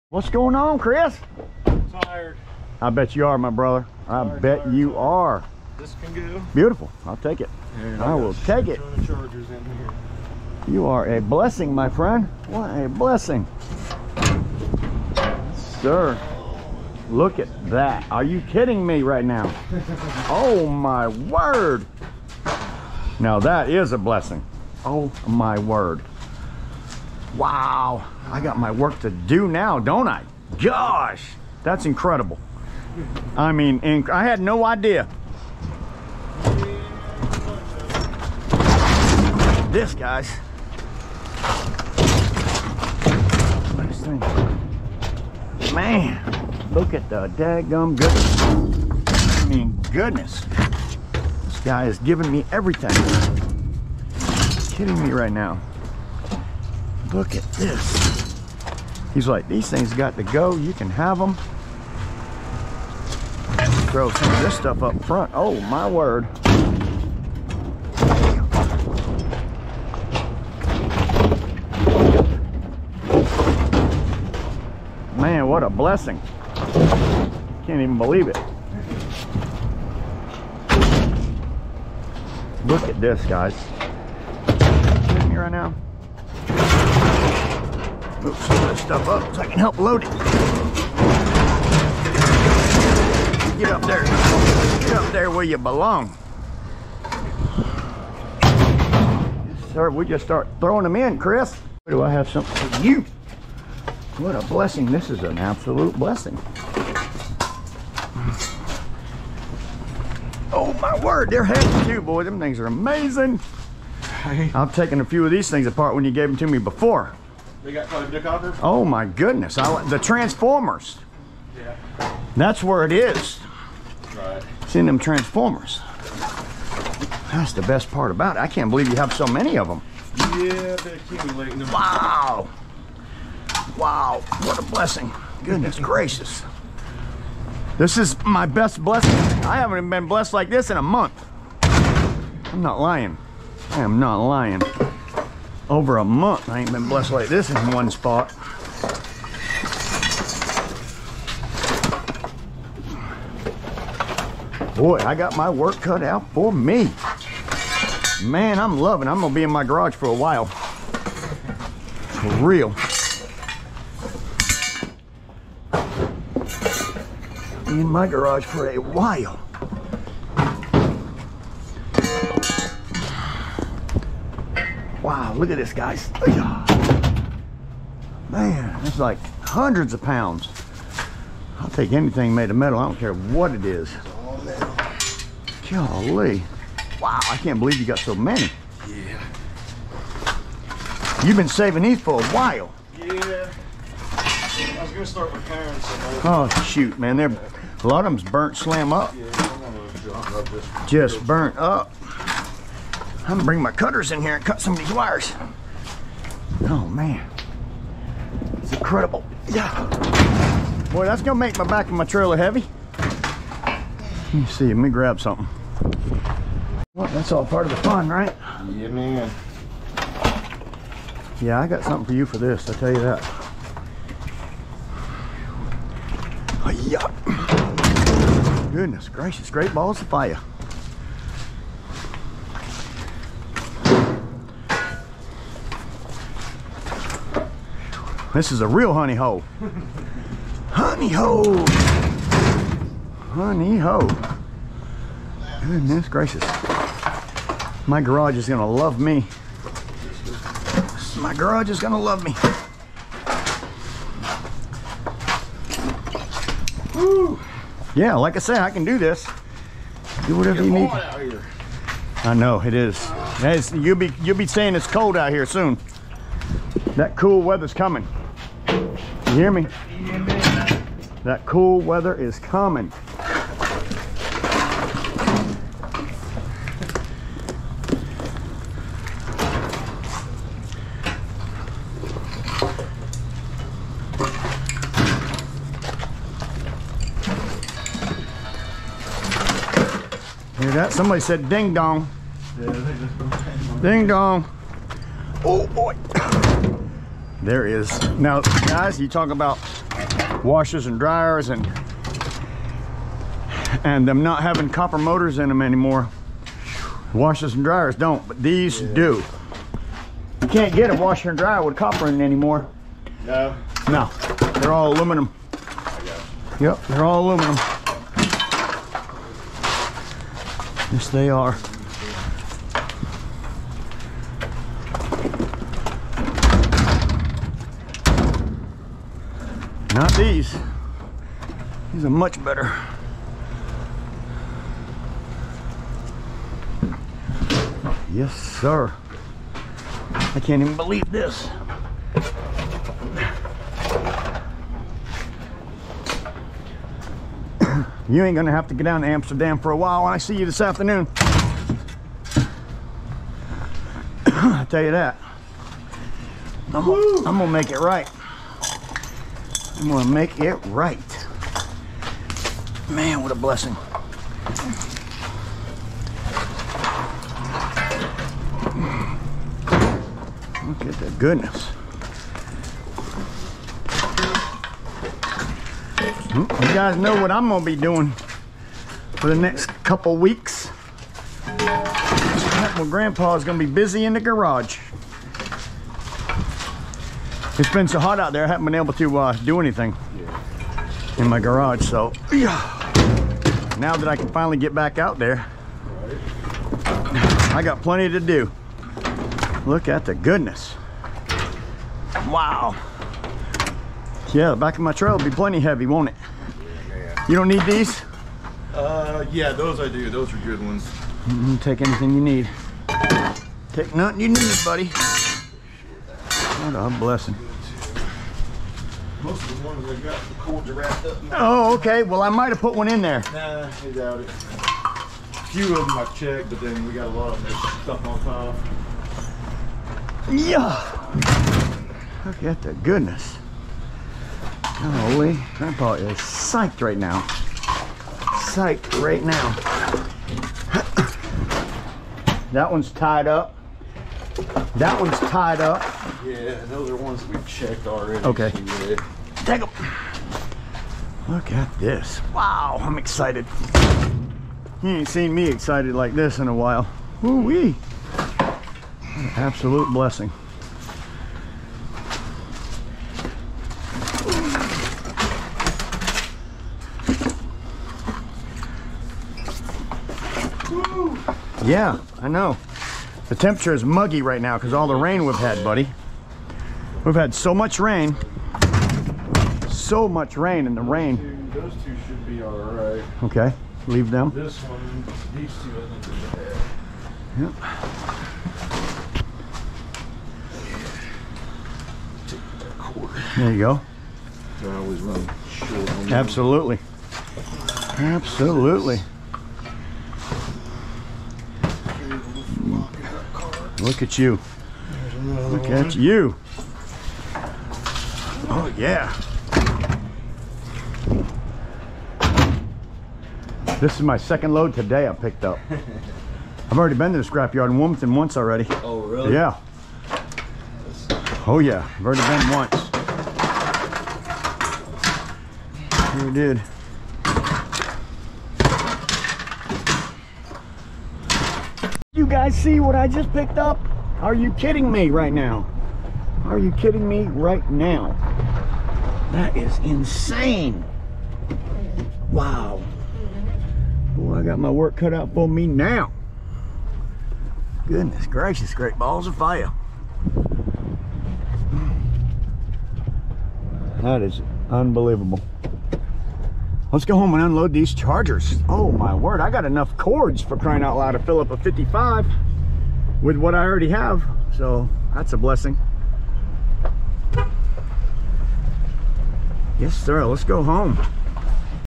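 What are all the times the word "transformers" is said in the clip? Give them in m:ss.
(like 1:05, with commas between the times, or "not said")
1:59, 2:04.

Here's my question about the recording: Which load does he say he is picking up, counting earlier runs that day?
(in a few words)
second load.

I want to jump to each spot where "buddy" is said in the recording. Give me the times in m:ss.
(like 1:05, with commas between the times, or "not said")
6:54, 7:55.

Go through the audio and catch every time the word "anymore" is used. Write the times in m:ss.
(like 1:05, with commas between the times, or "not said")
5:05, 5:12.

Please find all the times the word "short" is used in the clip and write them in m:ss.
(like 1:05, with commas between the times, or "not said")
8:15.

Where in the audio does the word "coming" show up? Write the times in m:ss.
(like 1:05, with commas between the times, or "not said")
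4:27, 4:32.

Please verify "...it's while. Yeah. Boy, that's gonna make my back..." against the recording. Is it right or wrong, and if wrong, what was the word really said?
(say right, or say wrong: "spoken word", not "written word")
wrong: "incredible", not "while".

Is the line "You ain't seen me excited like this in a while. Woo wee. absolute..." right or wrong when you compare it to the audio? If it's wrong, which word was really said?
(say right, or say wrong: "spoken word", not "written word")
right.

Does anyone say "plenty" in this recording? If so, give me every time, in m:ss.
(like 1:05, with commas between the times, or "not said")
6:37, 6:45.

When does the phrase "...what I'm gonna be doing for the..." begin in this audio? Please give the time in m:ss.
6:17.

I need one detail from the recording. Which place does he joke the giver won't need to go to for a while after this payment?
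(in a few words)
Amsterdam.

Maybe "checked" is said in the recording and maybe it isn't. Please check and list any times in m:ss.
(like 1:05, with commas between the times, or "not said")
7:06, 7:27.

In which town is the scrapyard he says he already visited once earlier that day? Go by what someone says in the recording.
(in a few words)
Wilmington.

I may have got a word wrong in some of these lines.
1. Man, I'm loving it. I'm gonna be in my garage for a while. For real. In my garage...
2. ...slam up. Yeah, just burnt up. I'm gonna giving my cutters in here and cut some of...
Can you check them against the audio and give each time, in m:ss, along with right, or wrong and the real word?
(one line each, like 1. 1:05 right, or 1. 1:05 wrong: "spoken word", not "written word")
1. 2:38 right
2. 3:18 wrong: "bring", not "giving".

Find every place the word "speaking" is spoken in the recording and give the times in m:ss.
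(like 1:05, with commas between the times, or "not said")
not said.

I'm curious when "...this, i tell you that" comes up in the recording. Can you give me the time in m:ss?
3:42.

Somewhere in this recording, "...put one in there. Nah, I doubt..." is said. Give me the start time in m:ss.
7:02.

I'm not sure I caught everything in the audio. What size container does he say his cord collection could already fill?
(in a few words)
a 55.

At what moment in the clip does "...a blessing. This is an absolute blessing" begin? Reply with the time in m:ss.
1:44.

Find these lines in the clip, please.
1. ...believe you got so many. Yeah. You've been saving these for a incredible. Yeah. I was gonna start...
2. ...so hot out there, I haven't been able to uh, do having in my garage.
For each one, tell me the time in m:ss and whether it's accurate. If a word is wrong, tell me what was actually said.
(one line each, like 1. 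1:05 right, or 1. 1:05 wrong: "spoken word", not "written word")
1. 3:07 wrong: "while", not "incredible"
2. 6:27 wrong: "anything", not "having".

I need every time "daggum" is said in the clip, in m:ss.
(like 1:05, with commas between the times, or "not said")
0:47.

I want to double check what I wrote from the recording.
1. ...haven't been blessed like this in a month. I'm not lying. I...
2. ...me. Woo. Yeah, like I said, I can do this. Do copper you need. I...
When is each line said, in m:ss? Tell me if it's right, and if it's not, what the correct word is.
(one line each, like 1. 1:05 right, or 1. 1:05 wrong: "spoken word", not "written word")
1. 2:19 right
2. 4:12 wrong: "whatever", not "copper".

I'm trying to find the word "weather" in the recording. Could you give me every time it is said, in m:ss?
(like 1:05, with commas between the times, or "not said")
4:27, 4:31.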